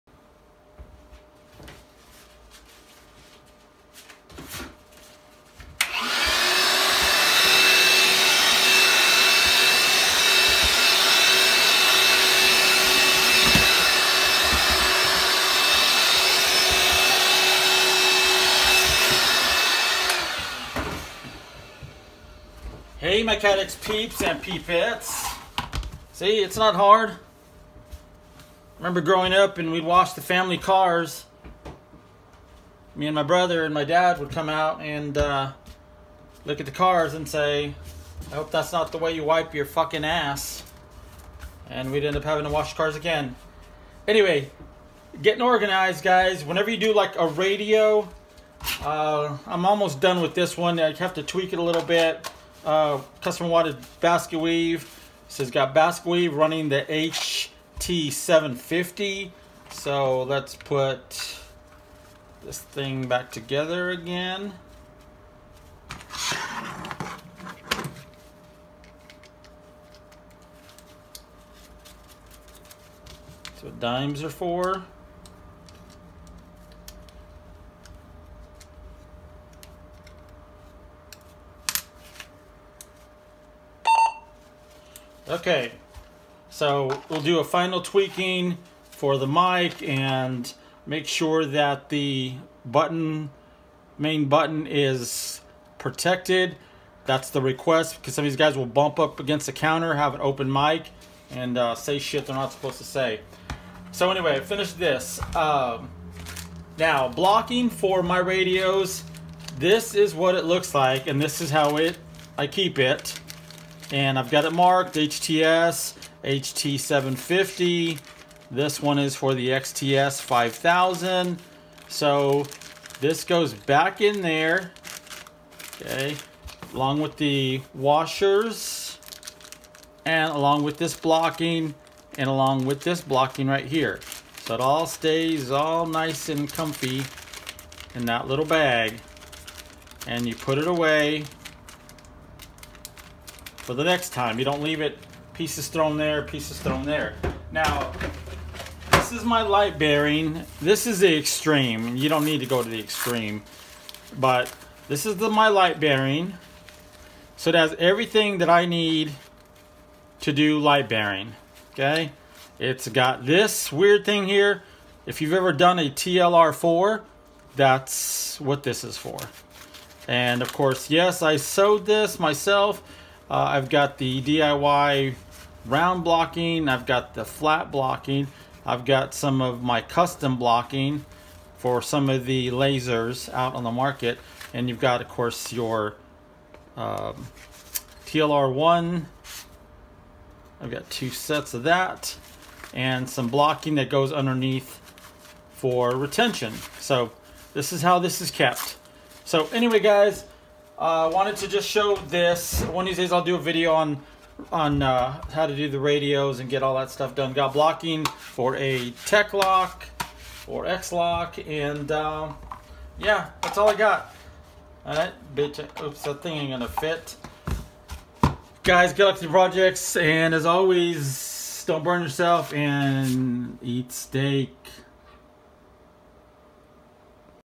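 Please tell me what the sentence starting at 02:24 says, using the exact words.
You don't leave it pieces thrown there, pieces thrown there.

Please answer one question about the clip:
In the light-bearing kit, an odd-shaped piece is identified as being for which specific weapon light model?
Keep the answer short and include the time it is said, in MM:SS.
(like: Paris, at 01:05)
TLR4, at 02:45.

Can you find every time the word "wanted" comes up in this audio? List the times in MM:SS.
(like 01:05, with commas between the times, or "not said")
03:21.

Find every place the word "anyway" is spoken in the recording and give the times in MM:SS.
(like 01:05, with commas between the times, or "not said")
00:44, 01:44, 03:19.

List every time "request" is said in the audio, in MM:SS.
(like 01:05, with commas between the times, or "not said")
01:37.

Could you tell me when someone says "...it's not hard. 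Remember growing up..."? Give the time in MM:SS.
00:26.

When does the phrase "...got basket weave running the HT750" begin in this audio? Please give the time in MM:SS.
00:55.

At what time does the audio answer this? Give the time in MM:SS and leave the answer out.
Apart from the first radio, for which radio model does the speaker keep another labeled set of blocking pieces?
01:59.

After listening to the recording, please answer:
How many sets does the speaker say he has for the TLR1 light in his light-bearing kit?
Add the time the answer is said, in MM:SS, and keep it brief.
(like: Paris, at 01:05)
2, at 03:10.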